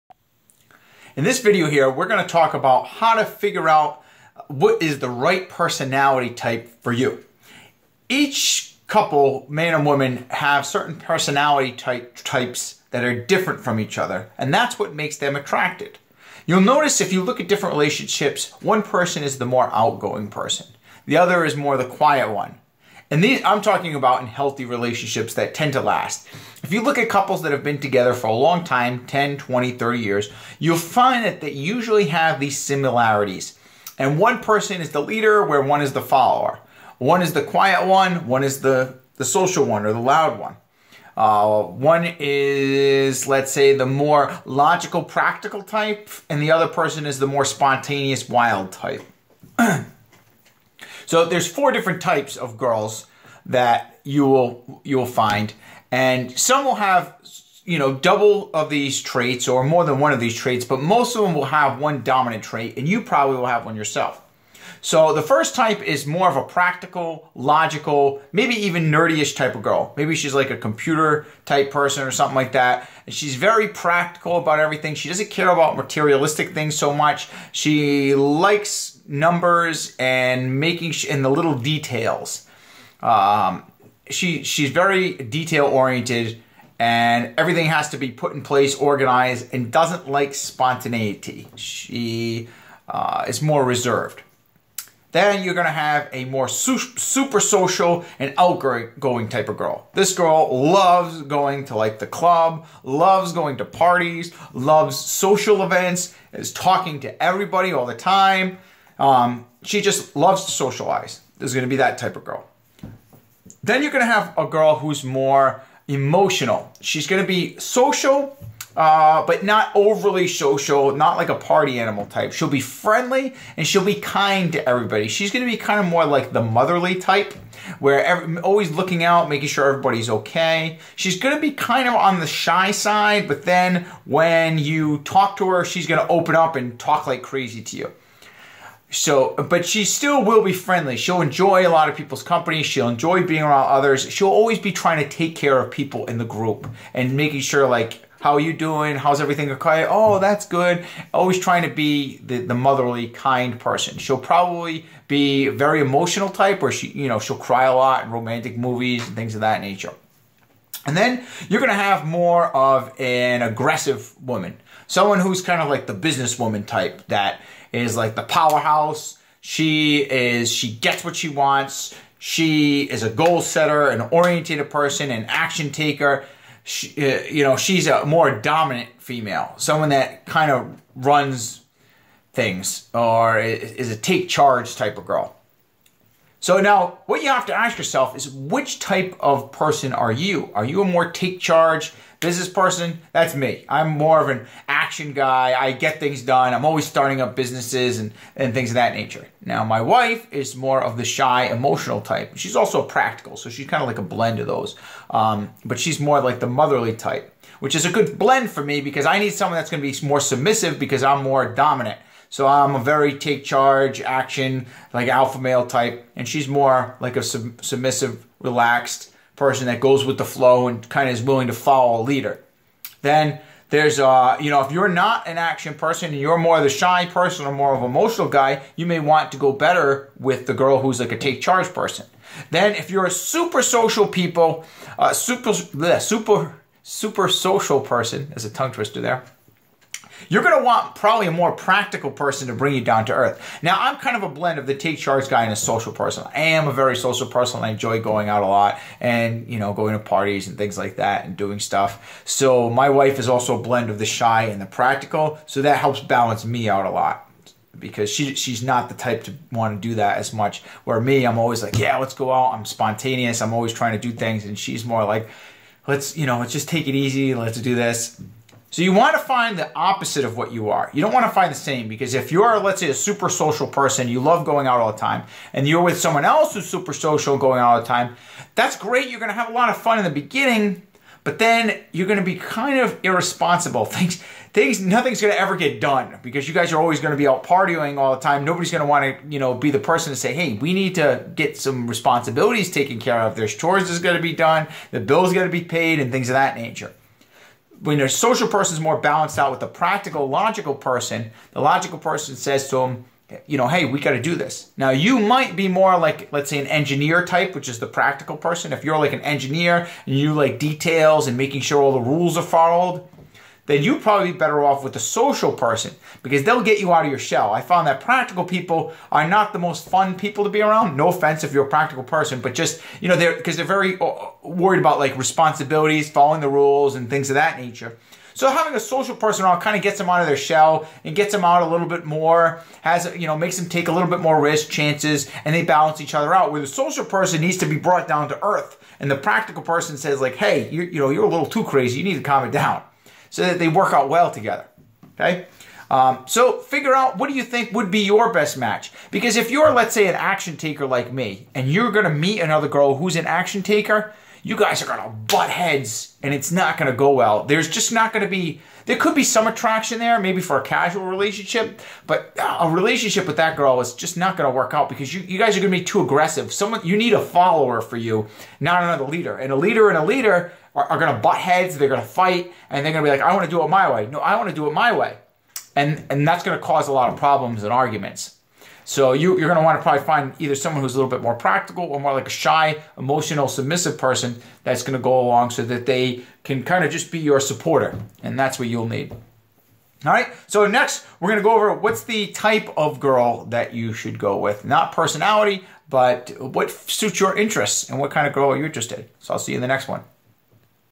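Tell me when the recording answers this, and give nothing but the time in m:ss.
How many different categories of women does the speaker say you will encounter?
0:51.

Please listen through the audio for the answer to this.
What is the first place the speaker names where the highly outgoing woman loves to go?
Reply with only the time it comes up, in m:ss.
1:41.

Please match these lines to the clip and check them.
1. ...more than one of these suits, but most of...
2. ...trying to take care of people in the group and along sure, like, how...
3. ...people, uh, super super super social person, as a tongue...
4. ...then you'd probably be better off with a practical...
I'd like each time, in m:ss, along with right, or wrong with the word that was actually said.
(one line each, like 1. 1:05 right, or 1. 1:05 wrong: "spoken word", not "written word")
1. 0:59 wrong: "traits", not "suits"
2. 2:24 wrong: "making", not "along"
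3. 3:54 right
4. 5:13 wrong: "social", not "practical".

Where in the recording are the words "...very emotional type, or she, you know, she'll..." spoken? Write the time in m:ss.
2:35.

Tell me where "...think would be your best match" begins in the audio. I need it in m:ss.
5:47.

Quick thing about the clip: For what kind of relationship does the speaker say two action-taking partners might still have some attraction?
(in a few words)
casual relationship.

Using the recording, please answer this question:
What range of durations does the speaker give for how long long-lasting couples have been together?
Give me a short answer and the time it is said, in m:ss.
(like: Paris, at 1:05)
10, 20, 30 years, at 0:29.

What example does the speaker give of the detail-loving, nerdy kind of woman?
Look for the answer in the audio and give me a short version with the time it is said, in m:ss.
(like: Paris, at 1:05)
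computer type person, at 1:10.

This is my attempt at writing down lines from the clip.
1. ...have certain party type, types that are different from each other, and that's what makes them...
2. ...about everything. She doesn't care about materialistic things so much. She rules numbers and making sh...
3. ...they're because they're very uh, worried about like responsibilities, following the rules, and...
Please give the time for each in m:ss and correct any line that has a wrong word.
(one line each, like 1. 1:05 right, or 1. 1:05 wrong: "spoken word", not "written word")
1. 0:10 wrong: "personality", not "party"
2. 1:14 wrong: "likes", not "rules"
3. 5:23 right.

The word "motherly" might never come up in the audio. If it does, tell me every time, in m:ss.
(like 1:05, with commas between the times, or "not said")
2:06, 2:32, 3:26.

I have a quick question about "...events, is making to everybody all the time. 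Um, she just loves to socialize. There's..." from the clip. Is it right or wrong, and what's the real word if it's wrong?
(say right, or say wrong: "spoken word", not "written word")
wrong: "talking", not "making".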